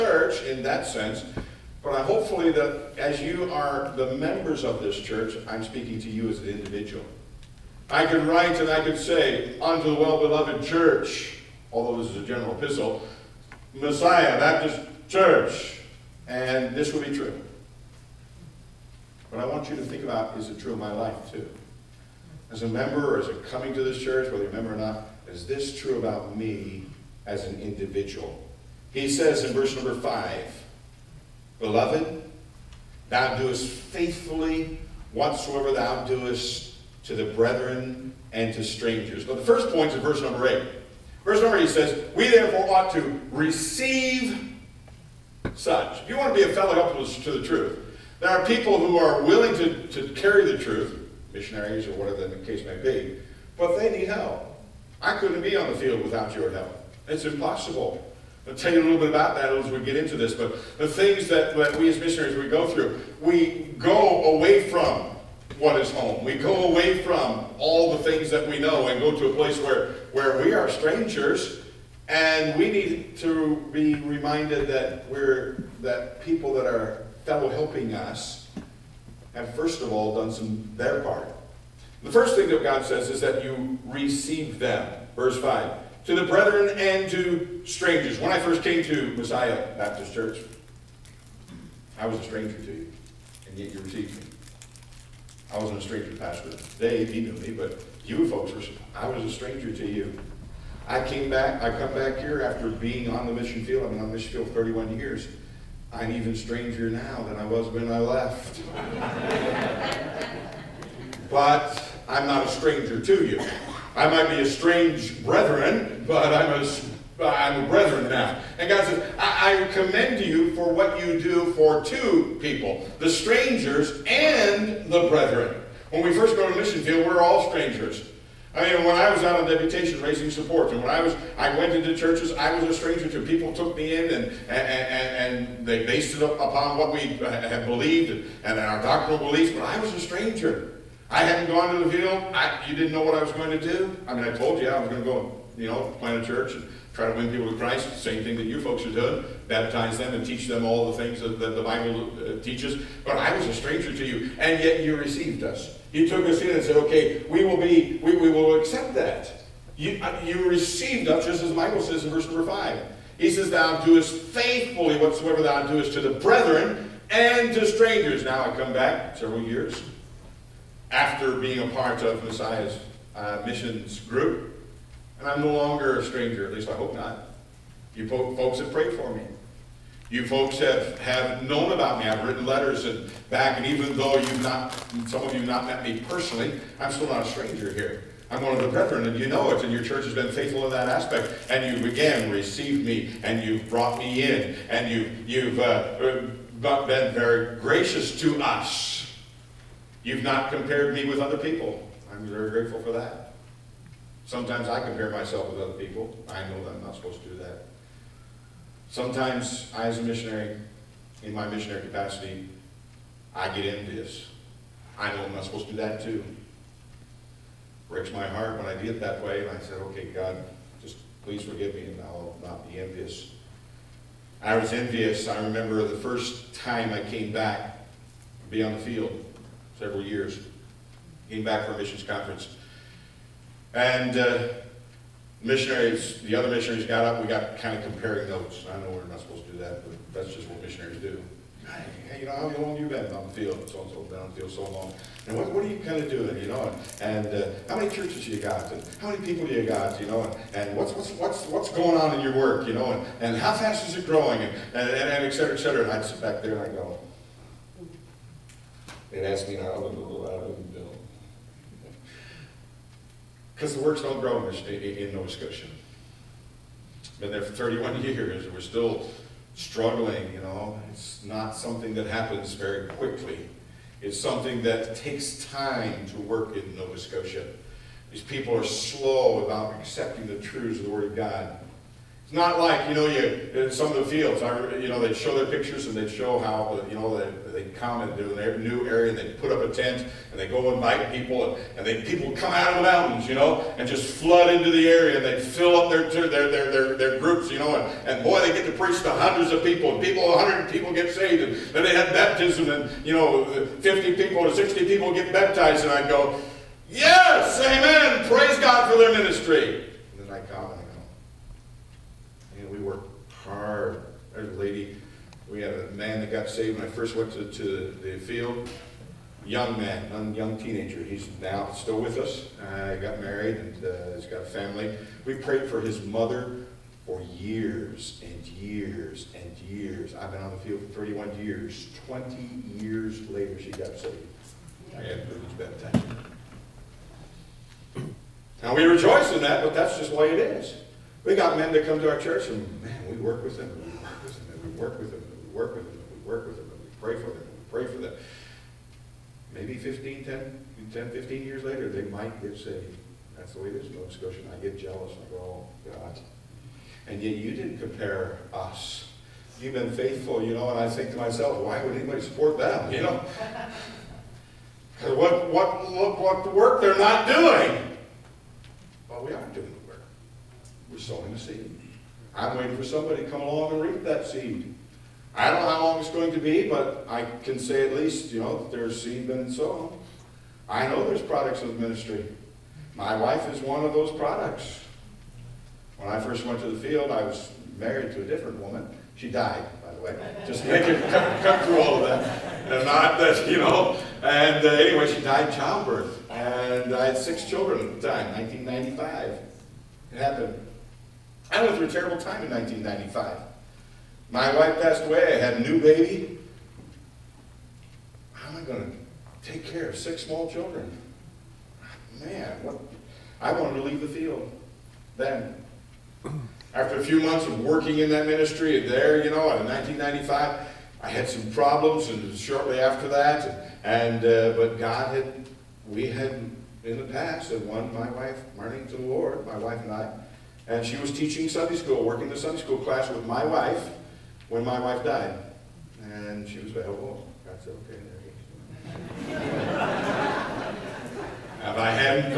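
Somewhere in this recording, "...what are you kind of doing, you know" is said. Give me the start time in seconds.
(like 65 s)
245 s.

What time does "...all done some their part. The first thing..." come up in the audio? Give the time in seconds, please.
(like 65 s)
79 s.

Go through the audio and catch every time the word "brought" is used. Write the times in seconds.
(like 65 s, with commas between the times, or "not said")
193 s.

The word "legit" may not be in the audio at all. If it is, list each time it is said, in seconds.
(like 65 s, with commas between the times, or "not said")
not said.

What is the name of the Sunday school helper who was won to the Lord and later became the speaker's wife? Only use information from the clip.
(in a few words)
Marnie.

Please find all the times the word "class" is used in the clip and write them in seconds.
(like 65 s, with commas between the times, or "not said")
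432 s.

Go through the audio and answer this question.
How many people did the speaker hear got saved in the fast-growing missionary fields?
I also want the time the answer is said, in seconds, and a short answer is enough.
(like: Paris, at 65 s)
100, at 300 s.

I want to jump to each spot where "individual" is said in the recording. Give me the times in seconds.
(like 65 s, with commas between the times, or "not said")
6 s, 27 s.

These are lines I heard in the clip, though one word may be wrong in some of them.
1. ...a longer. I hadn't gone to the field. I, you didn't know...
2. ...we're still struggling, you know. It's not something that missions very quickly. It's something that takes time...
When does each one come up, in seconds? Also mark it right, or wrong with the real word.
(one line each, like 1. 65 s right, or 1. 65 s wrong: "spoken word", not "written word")
1. 139 s wrong: "stranger", not "longer"
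2. 268 s wrong: "happens", not "missions".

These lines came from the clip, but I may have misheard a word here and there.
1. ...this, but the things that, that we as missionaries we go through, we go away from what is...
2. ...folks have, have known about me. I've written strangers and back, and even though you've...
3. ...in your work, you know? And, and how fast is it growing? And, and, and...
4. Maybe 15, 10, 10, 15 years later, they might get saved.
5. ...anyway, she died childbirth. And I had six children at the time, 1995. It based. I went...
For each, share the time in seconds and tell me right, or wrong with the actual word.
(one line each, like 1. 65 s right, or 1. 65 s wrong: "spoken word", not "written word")
1. 60 s right
2. 180 s wrong: "letters", not "strangers"
3. 252 s right
4. 349 s right
5. 394 s wrong: "happened", not "based".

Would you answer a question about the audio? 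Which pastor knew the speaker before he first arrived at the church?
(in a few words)
Pastor Dave.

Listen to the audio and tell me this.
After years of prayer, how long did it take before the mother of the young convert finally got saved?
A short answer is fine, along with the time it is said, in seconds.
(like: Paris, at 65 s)
20 years, at 332 s.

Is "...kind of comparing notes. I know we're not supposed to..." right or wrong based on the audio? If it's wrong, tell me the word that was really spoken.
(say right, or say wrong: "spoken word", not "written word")
right.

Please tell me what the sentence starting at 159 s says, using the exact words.
You, uh, you received us, just as the Bible says in verse number 5.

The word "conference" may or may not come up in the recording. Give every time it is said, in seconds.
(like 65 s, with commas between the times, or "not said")
232 s.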